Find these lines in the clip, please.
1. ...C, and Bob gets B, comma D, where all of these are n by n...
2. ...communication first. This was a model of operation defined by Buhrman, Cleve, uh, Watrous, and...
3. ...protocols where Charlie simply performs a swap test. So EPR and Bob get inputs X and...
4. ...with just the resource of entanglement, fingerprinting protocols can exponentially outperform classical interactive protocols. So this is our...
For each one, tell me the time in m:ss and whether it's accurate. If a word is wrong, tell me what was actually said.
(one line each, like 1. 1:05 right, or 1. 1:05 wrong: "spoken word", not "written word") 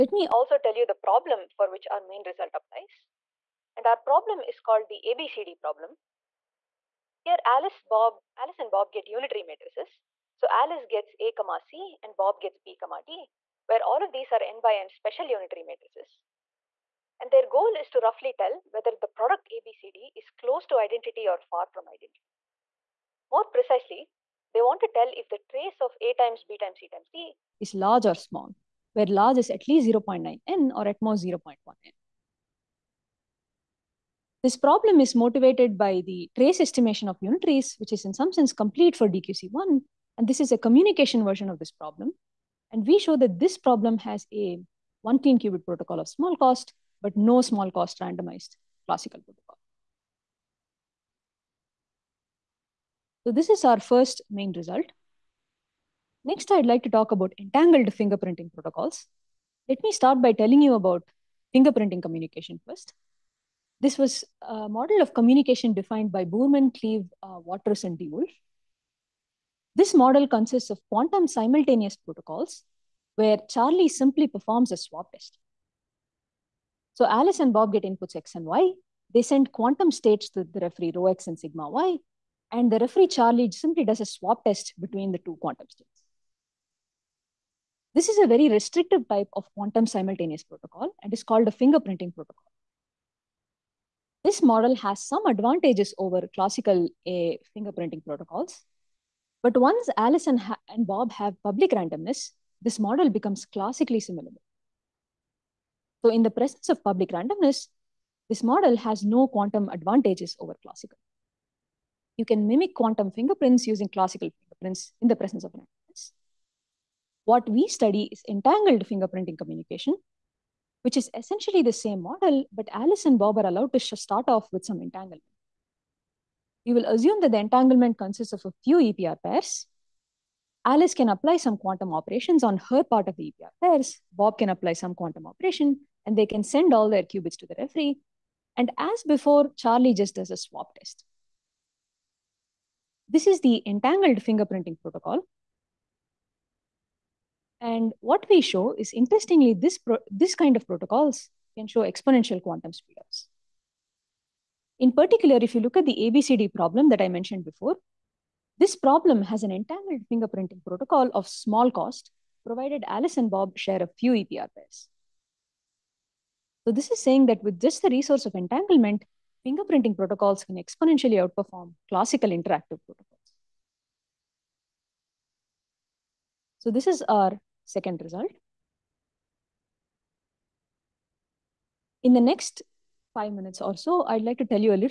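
1. 0:11 right
2. 1:02 wrong: "communication", not "operation"
3. 1:11 wrong: "Alice", not "EPR"
4. 2:47 right.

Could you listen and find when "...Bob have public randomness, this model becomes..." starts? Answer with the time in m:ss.
1:40.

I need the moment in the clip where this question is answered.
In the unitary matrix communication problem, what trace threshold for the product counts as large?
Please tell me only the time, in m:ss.
0:29.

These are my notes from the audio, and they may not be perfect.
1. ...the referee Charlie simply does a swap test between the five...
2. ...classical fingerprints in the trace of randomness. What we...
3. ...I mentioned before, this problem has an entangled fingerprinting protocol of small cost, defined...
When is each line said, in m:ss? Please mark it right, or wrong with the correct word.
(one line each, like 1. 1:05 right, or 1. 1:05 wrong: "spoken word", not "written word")
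1. 1:22 wrong: "two", not "five"
2. 1:53 wrong: "presence", not "trace"
3. 2:37 wrong: "provided", not "defined".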